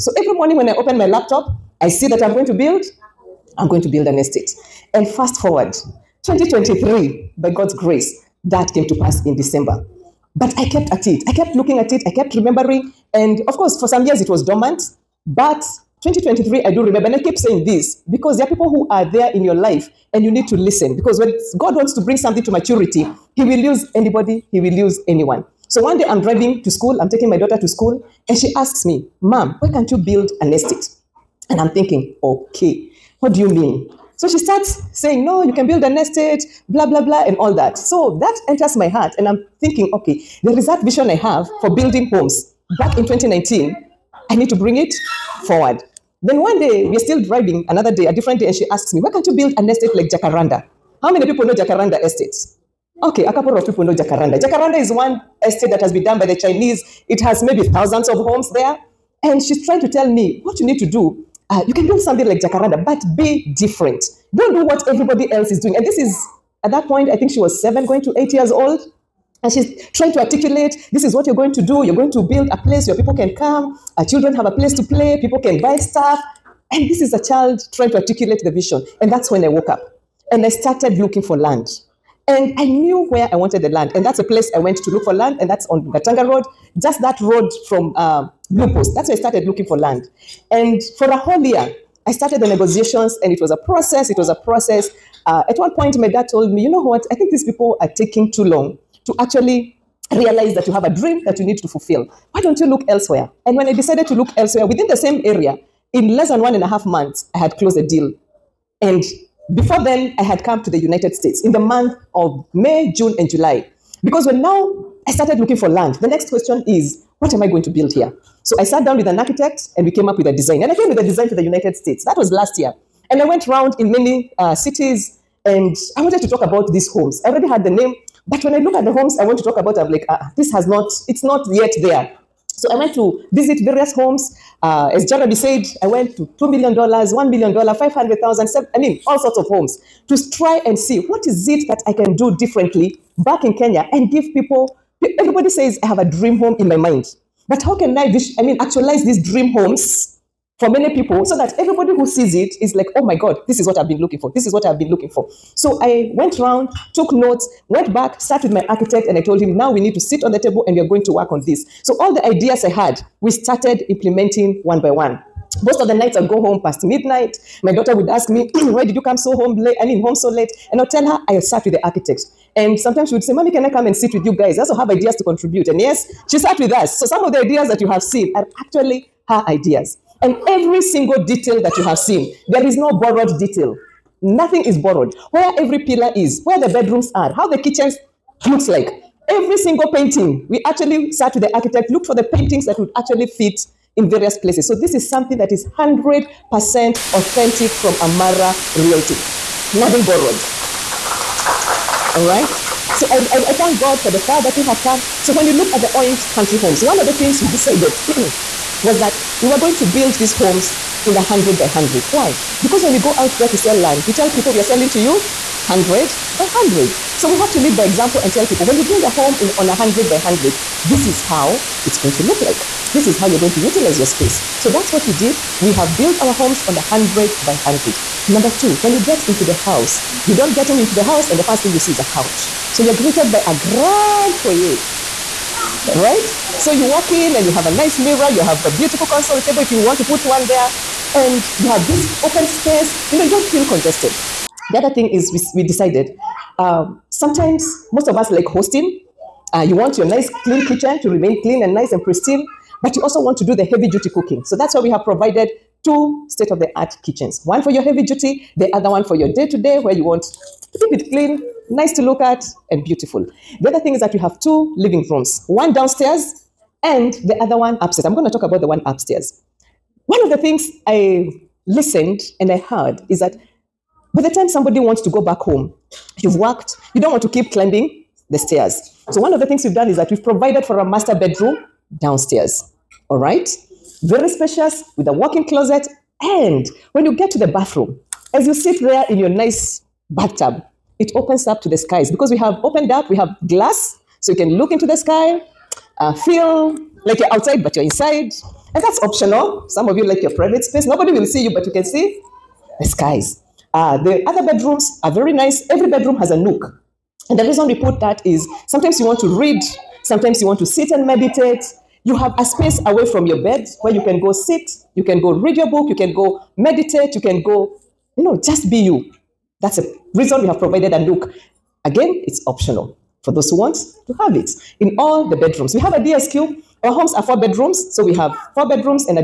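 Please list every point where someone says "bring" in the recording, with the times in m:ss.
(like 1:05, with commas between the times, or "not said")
0:21, 0:44.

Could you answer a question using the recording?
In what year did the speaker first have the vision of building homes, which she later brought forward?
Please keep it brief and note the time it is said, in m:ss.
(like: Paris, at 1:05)
2019, at 0:43.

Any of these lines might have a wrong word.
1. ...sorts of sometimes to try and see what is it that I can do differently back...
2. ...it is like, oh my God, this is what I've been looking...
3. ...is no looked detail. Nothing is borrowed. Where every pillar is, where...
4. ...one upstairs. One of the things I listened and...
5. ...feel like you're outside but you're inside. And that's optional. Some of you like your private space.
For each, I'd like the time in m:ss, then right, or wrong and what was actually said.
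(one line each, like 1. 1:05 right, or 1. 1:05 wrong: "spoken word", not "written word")
1. 2:19 wrong: "homes", not "sometimes"
2. 2:32 right
3. 3:02 wrong: "borrowed", not "looked"
4. 4:28 right
5. 4:56 right.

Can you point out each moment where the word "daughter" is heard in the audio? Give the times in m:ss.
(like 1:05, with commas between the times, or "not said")
0:27, 2:47.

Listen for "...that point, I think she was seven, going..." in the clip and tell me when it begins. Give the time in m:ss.
1:06.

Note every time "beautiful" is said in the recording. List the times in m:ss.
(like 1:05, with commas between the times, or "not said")
3:58, 4:22.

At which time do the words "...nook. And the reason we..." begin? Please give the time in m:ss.
5:06.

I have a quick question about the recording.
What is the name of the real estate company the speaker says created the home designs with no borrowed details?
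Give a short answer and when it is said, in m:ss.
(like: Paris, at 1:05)
Amara Realty, at 3:18.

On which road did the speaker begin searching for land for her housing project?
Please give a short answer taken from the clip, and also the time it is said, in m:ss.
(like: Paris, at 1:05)
Gatanga Road, at 1:25.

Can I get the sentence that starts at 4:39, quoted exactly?
So, one of the things we've done is that we've provided for a master bedroom downstairs.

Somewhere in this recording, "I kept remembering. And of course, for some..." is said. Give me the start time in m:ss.
0:12.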